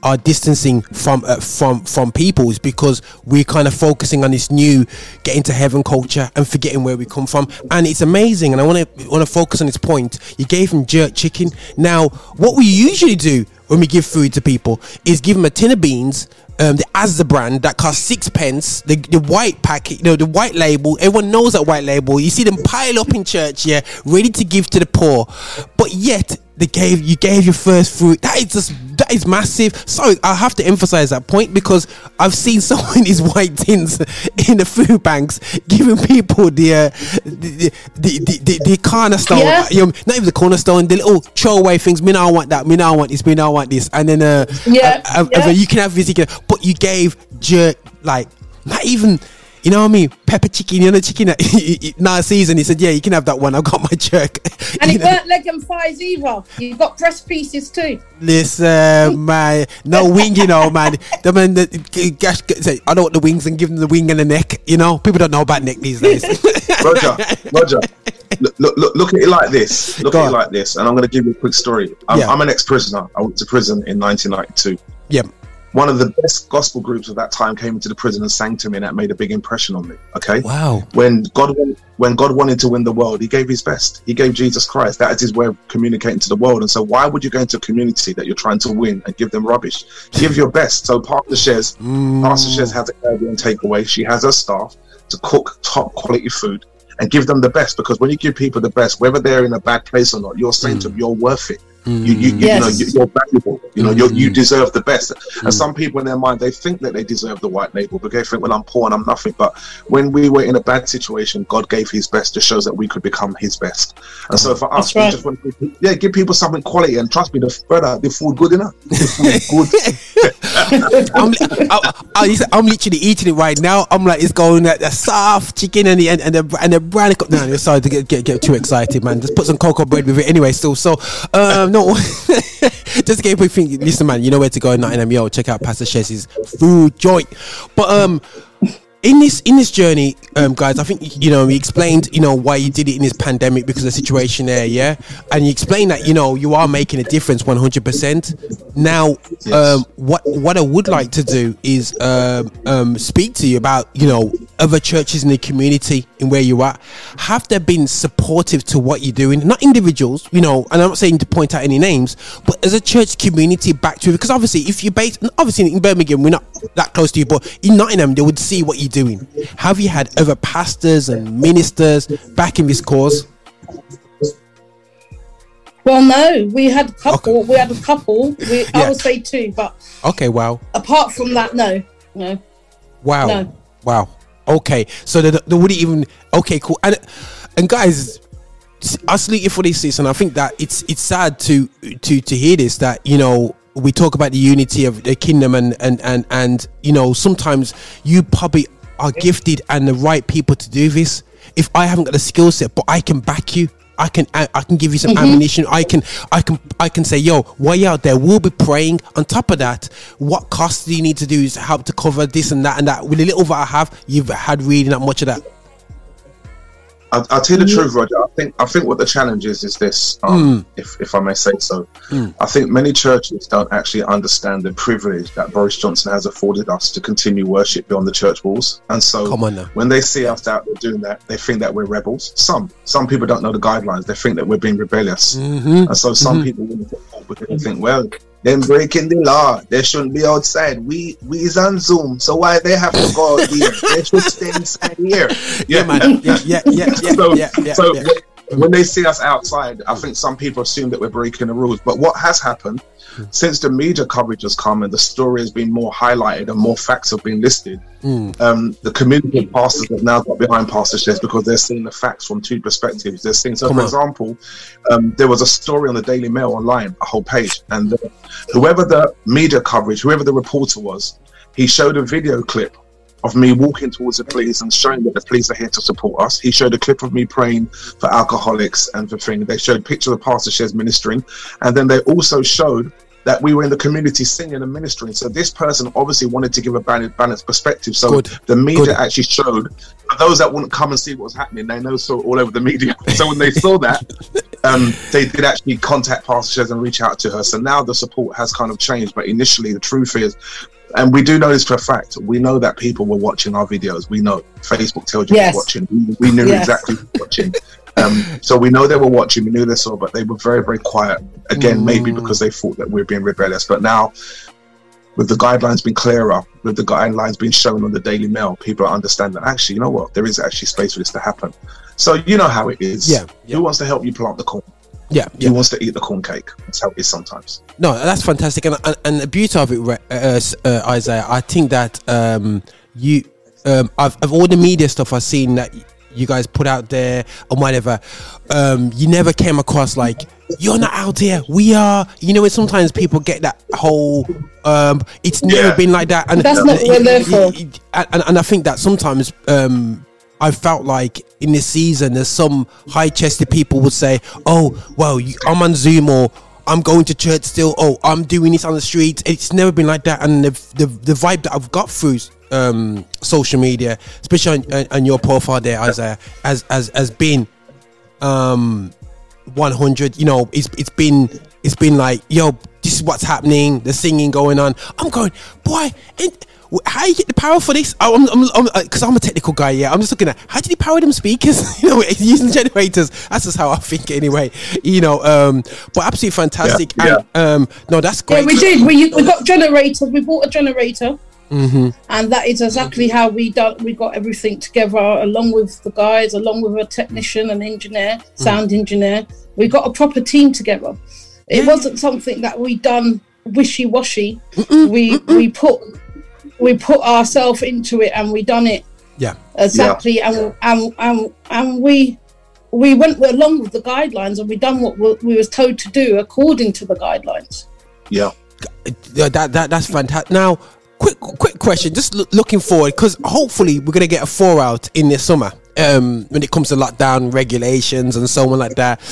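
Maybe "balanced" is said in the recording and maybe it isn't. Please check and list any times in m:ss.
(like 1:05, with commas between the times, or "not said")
4:46.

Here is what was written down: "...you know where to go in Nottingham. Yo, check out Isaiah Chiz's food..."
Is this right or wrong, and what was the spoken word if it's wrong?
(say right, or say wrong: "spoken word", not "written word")
wrong: "Pastor", not "Isaiah".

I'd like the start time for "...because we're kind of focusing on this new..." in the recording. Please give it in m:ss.
0:02.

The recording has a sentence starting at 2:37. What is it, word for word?
Have they been supportive to what you're doing?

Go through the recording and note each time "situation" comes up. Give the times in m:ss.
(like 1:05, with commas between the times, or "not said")
1:50, 2:23.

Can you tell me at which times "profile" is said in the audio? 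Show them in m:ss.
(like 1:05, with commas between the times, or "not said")
6:05.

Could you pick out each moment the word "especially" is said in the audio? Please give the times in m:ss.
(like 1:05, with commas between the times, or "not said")
6:04.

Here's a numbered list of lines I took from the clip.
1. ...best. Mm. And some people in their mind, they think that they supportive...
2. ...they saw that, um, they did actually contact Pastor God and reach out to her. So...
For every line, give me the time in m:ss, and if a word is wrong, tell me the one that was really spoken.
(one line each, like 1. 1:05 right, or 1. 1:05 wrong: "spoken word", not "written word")
1. 1:44 wrong: "deserve", not "supportive"
2. 4:53 wrong: "Chiz", not "God".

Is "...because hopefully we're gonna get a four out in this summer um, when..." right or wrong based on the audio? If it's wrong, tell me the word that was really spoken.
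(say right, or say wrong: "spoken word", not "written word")
right.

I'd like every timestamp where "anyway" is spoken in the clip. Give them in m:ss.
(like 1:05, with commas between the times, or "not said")
2:10, 6:24.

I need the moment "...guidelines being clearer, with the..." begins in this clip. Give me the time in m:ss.
5:15.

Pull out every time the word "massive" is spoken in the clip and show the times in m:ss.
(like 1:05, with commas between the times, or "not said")
0:29.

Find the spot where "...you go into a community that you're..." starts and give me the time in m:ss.
1:27.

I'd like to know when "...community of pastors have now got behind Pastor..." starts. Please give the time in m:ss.
4:18.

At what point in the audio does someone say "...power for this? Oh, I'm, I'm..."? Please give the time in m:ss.
6:17.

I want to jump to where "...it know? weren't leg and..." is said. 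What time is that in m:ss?
0:54.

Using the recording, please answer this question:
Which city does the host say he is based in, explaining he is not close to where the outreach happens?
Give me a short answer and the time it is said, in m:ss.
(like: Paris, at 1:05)
Birmingham, at 2:45.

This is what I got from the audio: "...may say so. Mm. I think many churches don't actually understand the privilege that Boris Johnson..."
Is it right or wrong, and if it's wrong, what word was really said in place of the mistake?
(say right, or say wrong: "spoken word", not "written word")
right.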